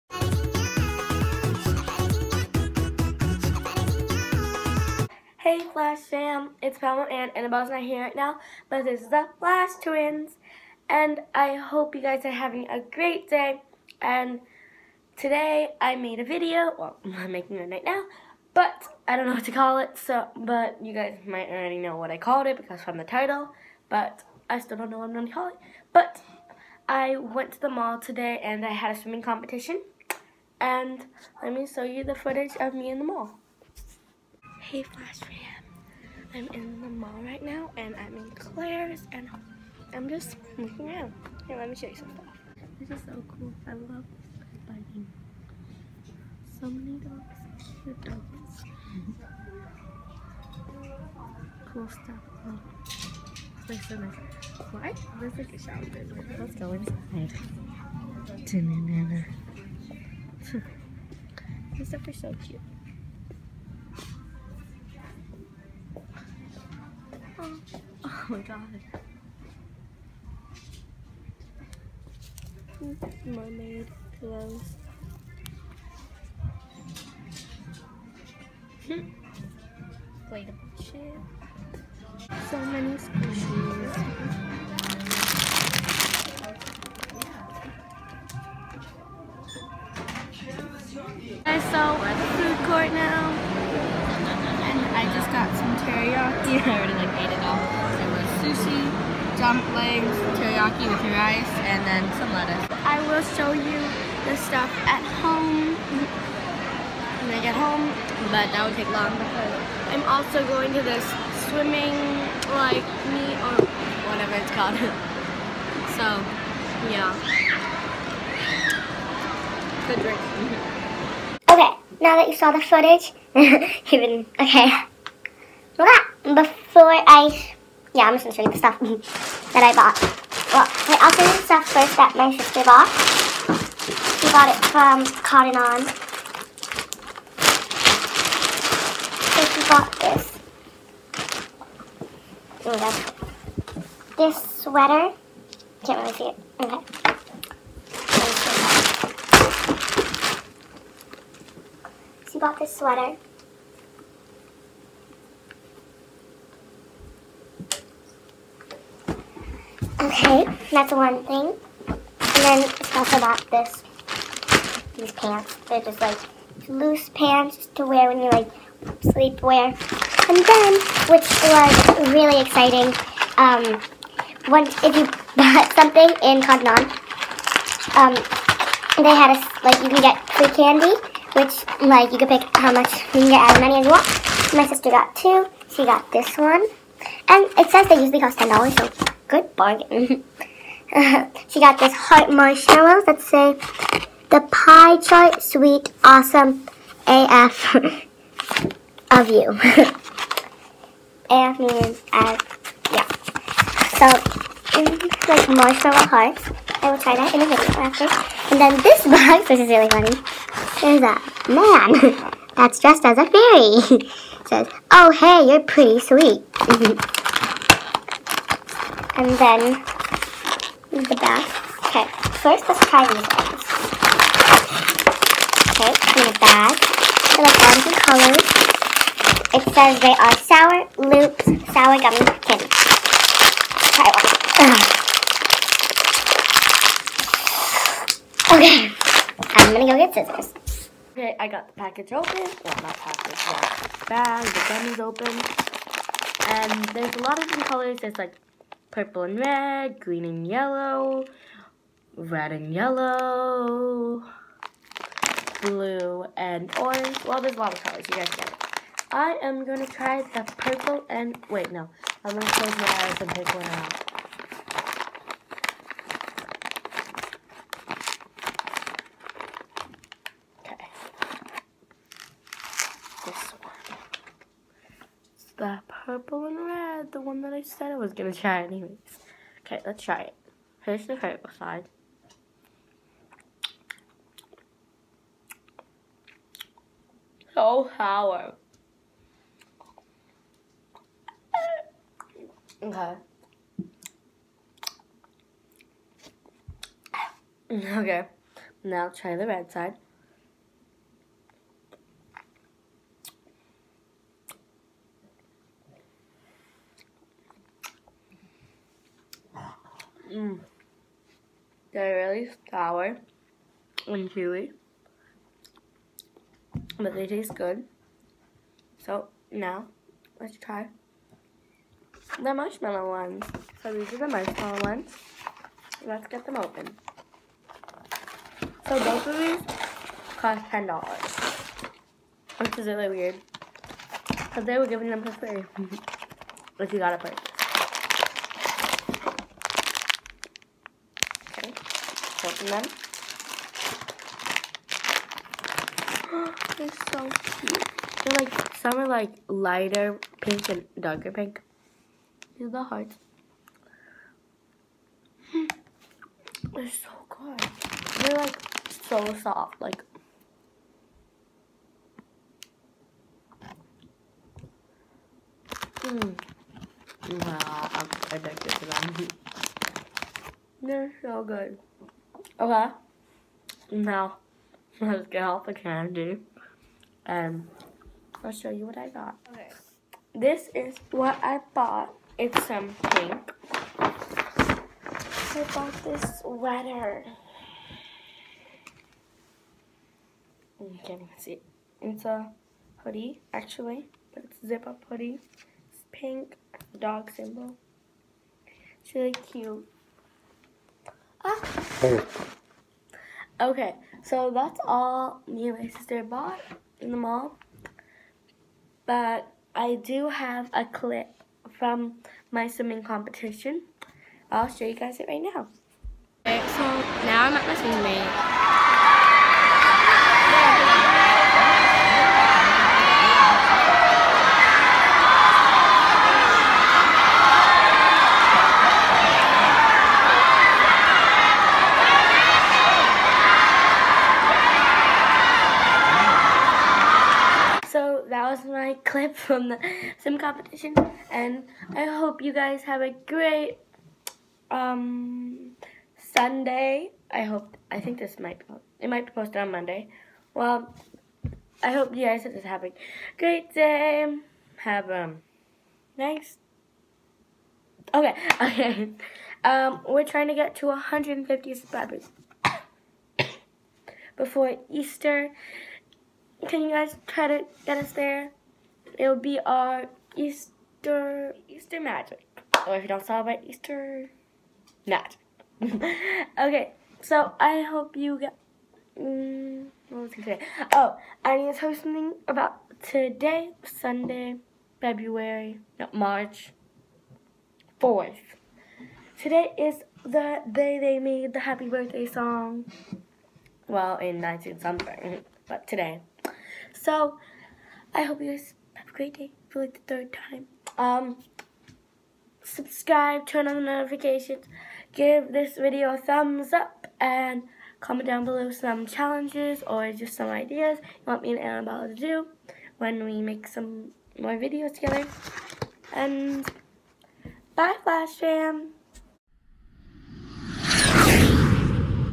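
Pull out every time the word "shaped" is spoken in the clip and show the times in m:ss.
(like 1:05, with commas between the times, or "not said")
not said.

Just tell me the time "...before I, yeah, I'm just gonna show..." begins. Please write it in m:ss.
2:06.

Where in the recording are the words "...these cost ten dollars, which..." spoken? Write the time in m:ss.
5:29.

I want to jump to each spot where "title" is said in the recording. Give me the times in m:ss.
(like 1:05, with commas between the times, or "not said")
0:23.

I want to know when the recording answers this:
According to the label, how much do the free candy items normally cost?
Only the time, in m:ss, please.
3:08.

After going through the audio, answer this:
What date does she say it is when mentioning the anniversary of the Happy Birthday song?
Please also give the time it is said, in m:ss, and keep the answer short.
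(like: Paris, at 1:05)
March 4, at 8:06.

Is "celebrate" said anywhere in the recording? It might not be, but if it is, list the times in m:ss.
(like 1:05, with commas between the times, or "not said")
7:53.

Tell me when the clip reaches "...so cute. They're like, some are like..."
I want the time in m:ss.
5:47.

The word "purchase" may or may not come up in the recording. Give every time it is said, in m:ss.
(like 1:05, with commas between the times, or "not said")
5:37.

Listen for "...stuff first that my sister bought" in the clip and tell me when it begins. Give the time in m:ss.
2:11.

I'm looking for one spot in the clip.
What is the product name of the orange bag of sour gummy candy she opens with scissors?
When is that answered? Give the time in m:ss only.
3:50.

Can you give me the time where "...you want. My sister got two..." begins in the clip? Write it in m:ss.
3:03.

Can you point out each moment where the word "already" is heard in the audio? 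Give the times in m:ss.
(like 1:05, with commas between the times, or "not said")
0:21, 1:36.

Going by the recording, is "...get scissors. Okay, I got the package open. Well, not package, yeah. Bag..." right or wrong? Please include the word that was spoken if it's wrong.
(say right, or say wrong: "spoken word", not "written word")
right.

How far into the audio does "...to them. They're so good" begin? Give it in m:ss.
6:08.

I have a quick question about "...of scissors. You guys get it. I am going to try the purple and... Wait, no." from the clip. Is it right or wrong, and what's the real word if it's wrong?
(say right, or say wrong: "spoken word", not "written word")
wrong: "colors", not "scissors".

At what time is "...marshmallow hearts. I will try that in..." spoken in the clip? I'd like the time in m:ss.
3:25.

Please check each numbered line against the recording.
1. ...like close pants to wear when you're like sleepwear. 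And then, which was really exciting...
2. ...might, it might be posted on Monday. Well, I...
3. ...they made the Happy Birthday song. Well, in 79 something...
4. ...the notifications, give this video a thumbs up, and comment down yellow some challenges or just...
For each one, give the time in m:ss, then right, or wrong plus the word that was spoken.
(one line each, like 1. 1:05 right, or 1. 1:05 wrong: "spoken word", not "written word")
1. 2:46 wrong: "loose", not "close"
2. 7:28 right
3. 8:10 wrong: "19", not "79"
4. 8:23 wrong: "below", not "yellow".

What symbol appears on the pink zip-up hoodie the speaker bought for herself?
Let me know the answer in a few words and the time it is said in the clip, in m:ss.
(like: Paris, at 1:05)
dog, at 6:36.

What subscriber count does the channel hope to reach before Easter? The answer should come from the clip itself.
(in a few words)
150.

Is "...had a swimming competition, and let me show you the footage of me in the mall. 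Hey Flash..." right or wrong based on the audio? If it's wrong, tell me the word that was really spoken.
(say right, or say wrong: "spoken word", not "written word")
right.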